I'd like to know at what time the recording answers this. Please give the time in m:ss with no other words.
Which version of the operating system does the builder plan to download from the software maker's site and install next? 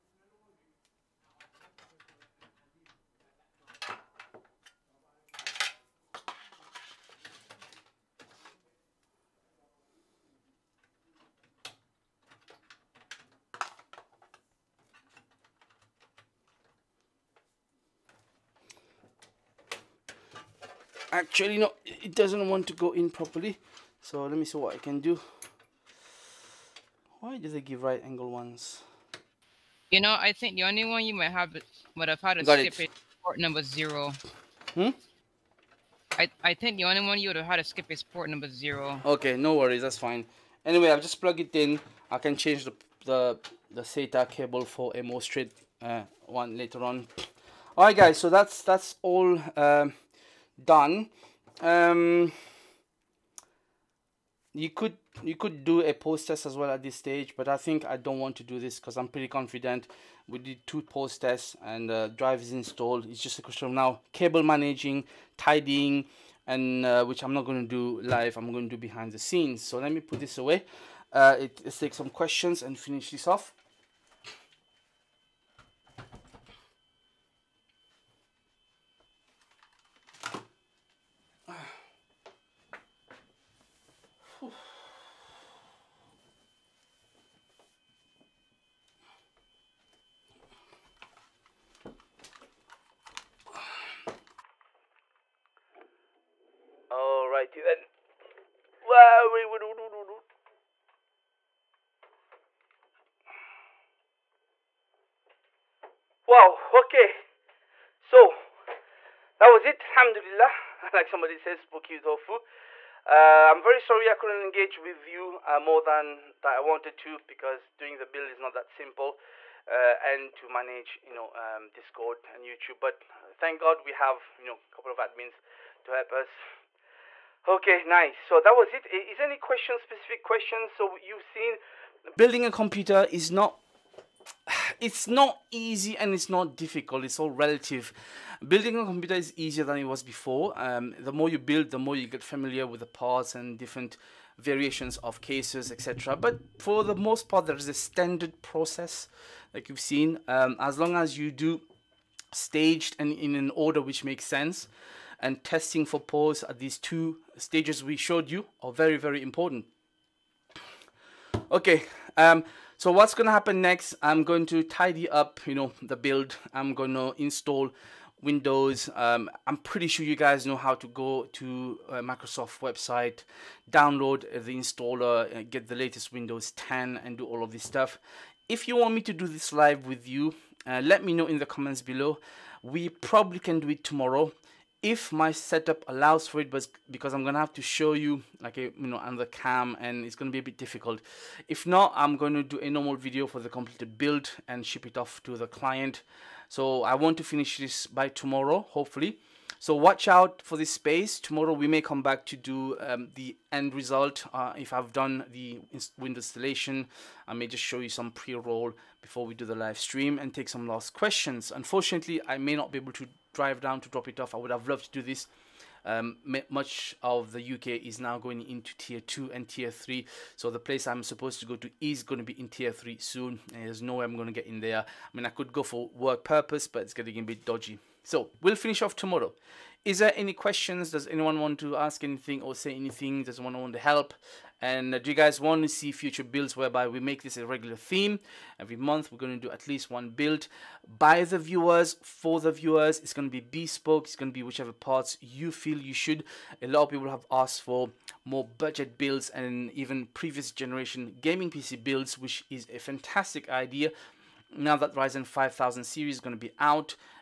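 2:56.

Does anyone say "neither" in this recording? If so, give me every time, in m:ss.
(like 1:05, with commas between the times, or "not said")
not said.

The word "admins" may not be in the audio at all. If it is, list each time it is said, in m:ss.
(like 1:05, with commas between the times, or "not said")
2:04.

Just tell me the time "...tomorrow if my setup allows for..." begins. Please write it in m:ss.
3:03.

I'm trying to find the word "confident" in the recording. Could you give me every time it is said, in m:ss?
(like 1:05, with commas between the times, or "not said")
0:59.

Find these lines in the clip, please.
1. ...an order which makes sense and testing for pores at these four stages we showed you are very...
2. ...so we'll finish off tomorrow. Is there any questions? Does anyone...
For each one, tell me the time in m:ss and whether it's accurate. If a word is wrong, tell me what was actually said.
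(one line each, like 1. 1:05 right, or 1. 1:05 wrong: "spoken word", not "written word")
1. 2:33 wrong: "two", not "four"
2. 3:48 right.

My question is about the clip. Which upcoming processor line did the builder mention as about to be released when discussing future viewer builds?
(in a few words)
Ryzen 5000 series.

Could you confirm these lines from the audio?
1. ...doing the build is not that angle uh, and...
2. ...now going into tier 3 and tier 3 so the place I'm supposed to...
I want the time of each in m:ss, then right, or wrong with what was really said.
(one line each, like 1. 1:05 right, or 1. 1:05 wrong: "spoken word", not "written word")
1. 1:57 wrong: "simple", not "angle"
2. 3:37 wrong: "2", not "3".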